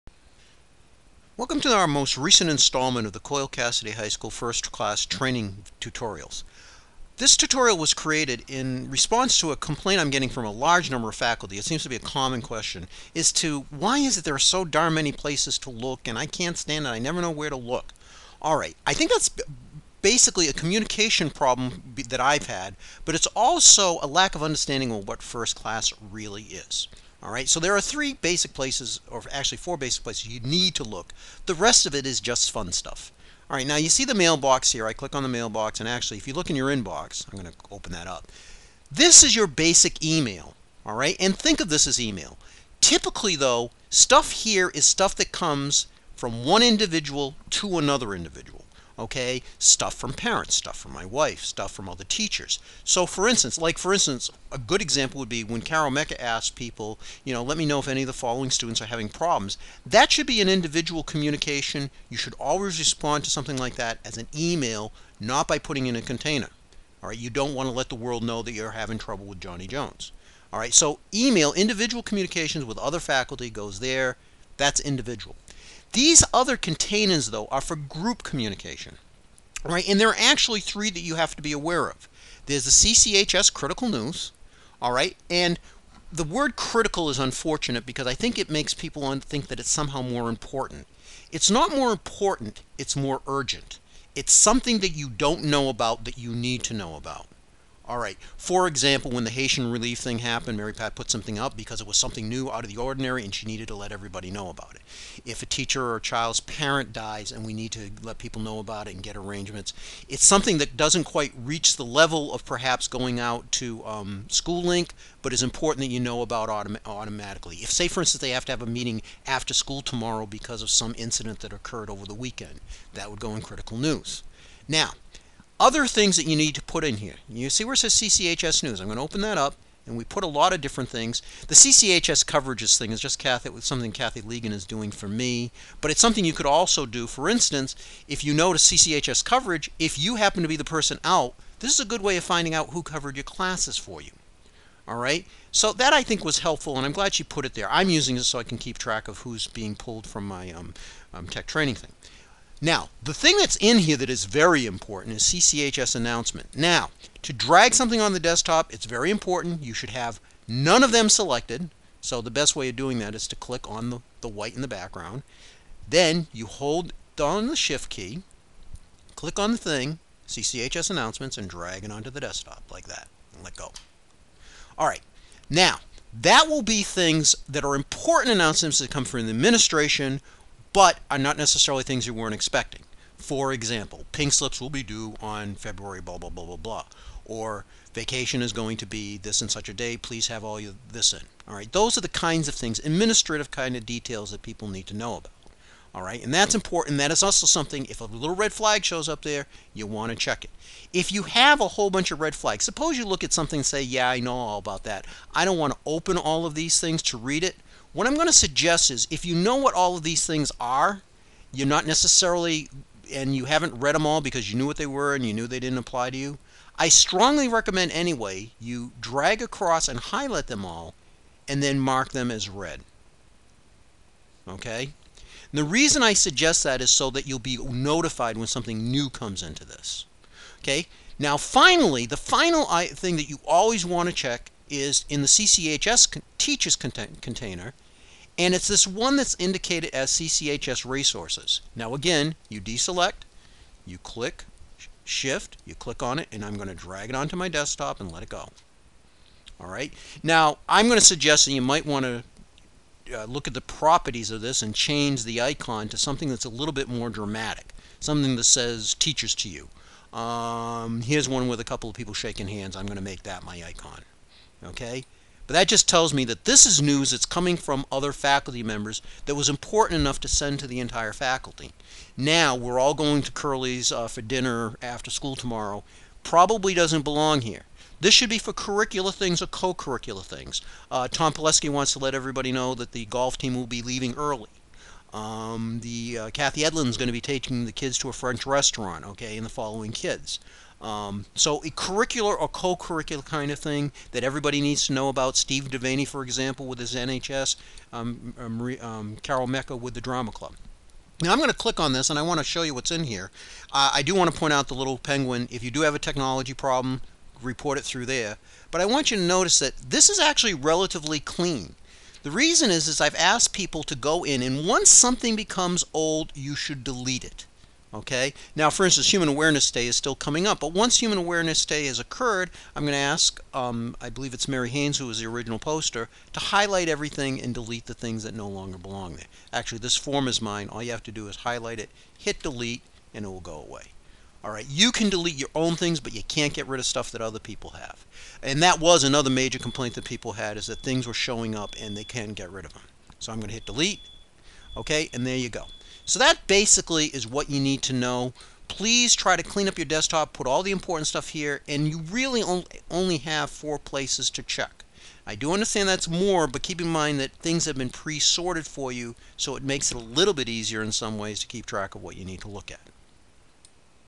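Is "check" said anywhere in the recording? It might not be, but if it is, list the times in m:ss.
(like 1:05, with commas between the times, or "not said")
3:20, 3:54, 5:54.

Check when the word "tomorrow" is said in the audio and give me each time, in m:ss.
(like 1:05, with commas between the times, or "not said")
1:59, 4:35.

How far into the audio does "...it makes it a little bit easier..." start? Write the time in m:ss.
5:59.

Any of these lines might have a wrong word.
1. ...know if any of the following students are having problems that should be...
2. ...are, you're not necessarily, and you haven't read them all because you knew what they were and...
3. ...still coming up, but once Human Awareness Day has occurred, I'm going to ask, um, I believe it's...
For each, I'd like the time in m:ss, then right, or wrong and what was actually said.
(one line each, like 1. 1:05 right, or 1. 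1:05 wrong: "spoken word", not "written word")
1. 0:57 right
2. 3:30 right
3. 5:19 right.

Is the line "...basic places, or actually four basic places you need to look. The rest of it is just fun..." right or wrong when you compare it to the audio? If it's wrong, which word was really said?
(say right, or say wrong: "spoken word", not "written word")
right.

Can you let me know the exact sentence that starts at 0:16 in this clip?
I never know where to look.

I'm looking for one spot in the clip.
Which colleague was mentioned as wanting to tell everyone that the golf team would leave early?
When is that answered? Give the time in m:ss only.
4:41.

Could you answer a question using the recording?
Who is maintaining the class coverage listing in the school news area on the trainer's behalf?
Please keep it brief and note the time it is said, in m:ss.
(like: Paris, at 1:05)
Kathy Legan, at 2:13.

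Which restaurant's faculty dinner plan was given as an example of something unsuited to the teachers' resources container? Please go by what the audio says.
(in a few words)
Curly's.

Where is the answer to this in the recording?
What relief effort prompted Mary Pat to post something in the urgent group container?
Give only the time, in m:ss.
1:39.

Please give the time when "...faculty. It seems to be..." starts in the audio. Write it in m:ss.
0:11.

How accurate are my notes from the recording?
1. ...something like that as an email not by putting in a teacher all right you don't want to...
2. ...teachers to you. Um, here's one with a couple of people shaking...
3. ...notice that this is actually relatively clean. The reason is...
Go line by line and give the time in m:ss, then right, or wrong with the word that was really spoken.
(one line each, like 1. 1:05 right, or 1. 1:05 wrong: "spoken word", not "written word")
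1. 1:03 wrong: "container", not "teacher"
2. 4:18 right
3. 5:09 right.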